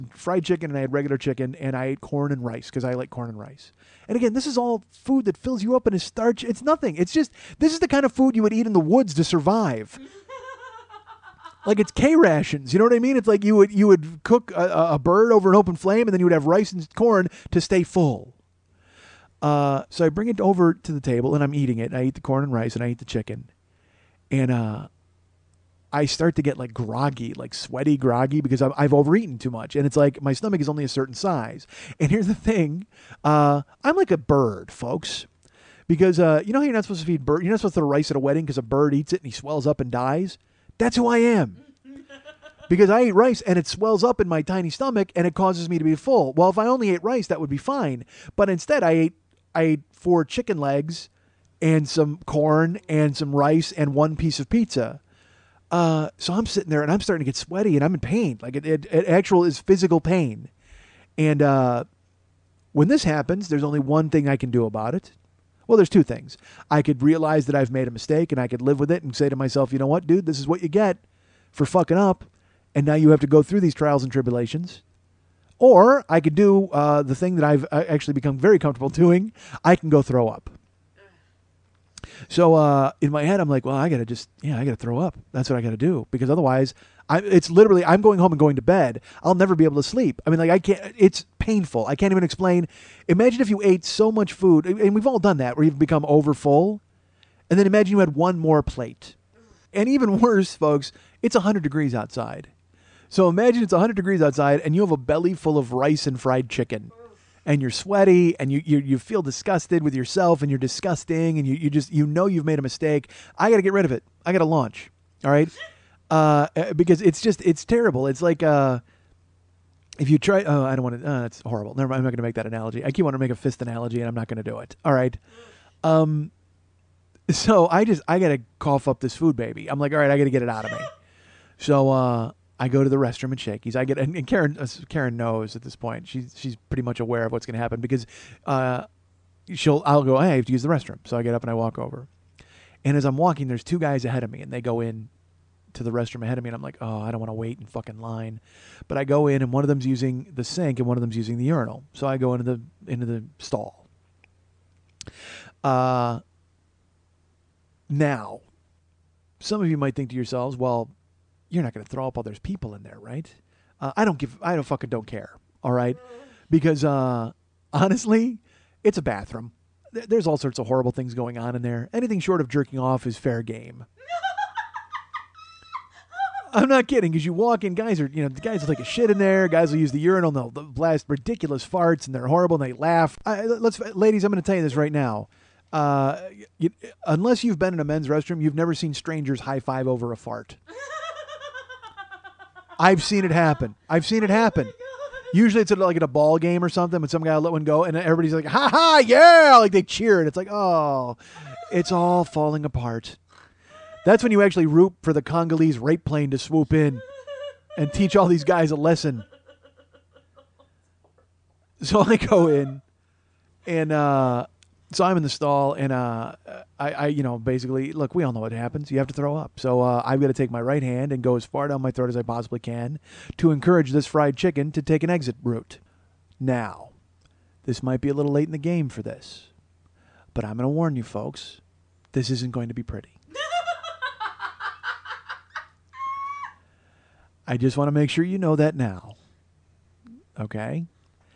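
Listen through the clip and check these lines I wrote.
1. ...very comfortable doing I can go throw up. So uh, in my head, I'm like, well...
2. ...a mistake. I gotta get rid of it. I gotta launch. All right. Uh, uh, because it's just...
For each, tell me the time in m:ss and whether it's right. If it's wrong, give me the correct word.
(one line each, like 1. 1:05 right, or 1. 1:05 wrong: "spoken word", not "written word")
1. 1:18 right
2. 1:52 right.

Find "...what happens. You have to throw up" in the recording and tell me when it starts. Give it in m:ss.
3:38.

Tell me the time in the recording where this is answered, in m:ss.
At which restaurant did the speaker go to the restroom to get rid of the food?
2:13.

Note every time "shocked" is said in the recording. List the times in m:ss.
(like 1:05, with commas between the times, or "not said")
not said.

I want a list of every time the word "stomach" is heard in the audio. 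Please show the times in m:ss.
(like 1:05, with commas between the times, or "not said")
0:30, 0:44.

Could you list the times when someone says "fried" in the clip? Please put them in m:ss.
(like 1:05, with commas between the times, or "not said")
0:00, 1:46, 3:44.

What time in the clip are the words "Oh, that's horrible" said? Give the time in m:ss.
2:01.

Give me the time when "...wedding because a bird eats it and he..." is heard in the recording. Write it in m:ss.
0:38.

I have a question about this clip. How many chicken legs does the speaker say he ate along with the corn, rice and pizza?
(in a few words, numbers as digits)
4.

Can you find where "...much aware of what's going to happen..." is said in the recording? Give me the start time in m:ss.
2:16.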